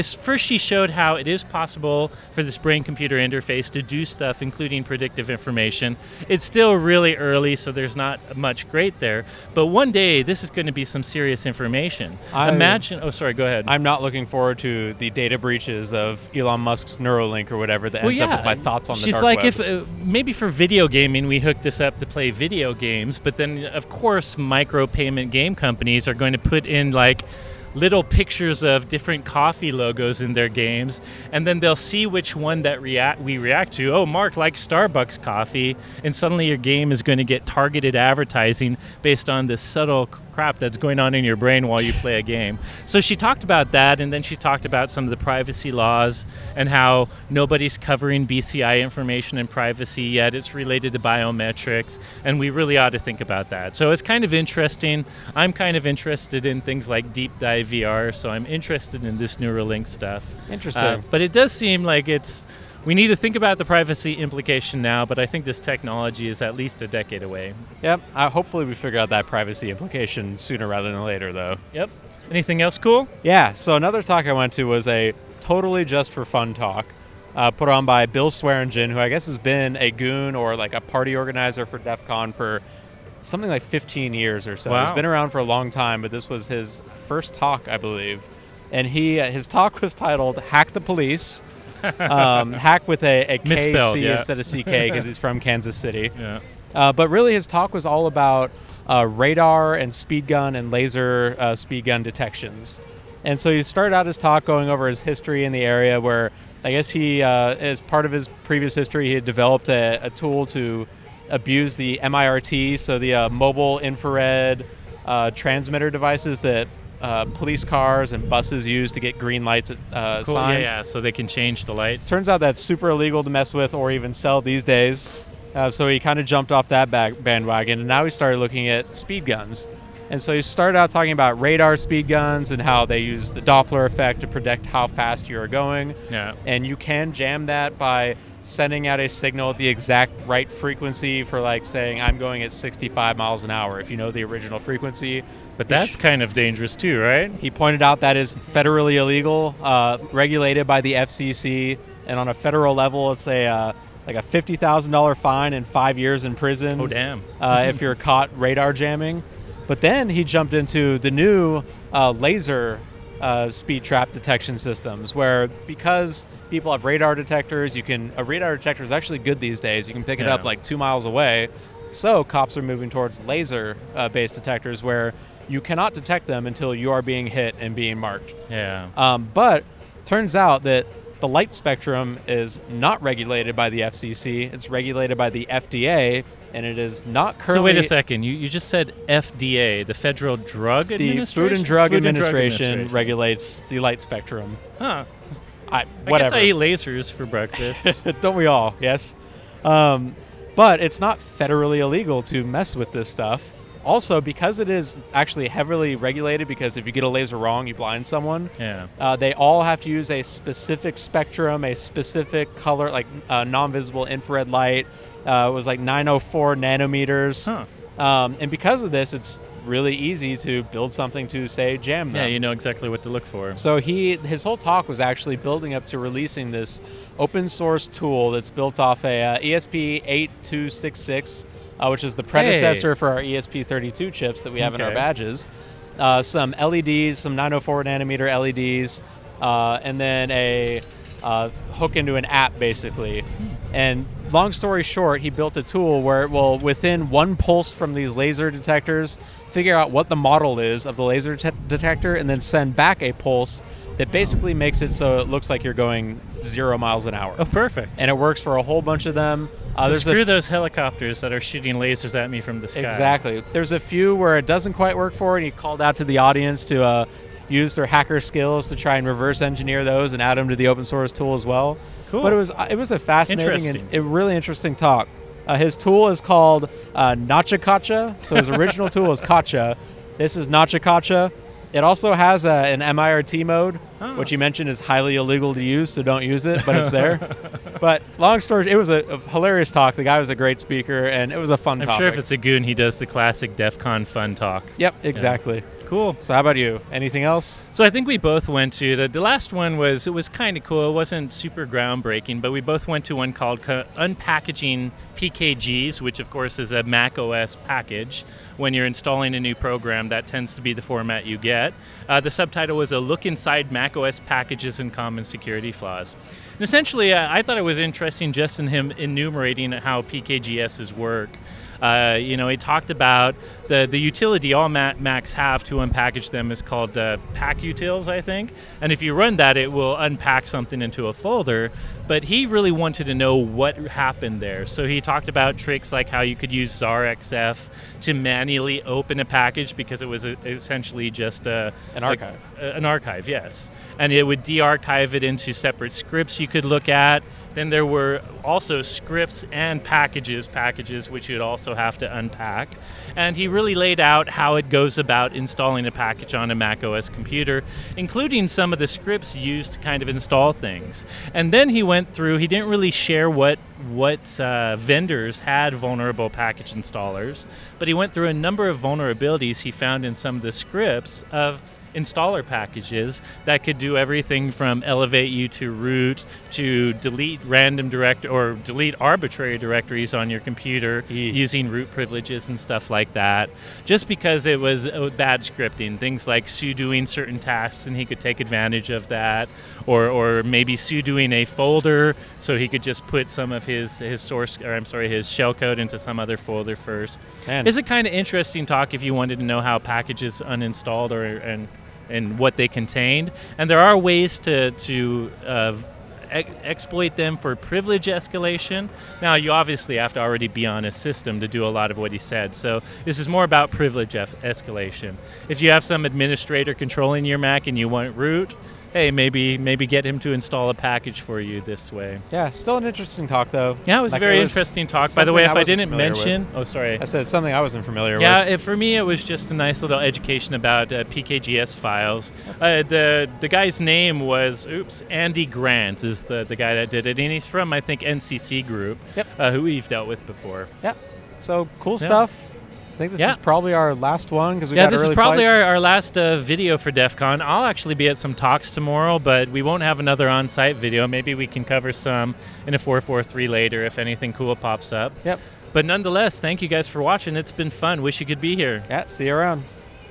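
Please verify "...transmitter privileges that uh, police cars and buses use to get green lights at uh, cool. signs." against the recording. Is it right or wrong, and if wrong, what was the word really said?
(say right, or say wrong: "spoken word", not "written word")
wrong: "devices", not "privileges".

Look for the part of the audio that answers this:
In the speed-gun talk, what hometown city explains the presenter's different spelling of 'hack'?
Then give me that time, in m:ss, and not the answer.
1:35.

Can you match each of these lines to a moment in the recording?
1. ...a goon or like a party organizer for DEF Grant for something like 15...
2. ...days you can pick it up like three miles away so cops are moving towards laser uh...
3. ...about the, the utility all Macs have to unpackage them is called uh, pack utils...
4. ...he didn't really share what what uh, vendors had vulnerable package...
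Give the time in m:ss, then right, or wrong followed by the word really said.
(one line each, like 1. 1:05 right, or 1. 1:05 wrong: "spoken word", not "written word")
1. 1:19 wrong: "CON", not "Grant"
2. 2:49 wrong: "two", not "three"
3. 5:22 right
4. 6:02 right.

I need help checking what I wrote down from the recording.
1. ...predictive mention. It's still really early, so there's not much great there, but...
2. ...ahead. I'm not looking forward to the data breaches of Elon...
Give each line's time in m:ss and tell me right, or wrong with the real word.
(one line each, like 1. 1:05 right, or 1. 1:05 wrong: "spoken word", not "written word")
1. 0:04 wrong: "information", not "mention"
2. 0:13 right.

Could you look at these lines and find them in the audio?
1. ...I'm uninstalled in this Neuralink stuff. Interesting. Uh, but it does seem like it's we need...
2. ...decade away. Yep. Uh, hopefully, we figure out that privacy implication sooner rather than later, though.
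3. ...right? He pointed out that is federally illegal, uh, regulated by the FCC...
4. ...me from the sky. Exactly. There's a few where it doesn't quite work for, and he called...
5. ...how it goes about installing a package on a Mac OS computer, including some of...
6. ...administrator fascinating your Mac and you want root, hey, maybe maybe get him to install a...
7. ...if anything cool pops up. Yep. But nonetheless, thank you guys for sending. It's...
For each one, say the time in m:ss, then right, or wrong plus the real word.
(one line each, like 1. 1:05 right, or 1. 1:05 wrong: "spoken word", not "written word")
1. 0:58 wrong: "interested", not "uninstalled"
2. 1:06 right
3. 2:26 right
4. 4:22 right
5. 5:54 right
6. 6:56 wrong: "controlling", not "fascinating"
7. 7:33 wrong: "watching", not "sending".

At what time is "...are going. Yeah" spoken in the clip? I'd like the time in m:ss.
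2:15.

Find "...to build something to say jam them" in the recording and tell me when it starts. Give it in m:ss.
3:40.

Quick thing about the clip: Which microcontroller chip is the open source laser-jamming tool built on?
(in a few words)
ESP8266.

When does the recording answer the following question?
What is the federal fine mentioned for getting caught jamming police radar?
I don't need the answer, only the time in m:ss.
2:34.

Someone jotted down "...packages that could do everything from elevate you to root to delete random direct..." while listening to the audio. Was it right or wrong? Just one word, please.
right.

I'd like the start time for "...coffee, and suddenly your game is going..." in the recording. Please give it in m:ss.
0:35.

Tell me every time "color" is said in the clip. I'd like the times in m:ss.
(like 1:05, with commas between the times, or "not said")
3:32.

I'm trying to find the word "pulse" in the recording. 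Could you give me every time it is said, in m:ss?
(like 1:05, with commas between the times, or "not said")
4:07, 4:13.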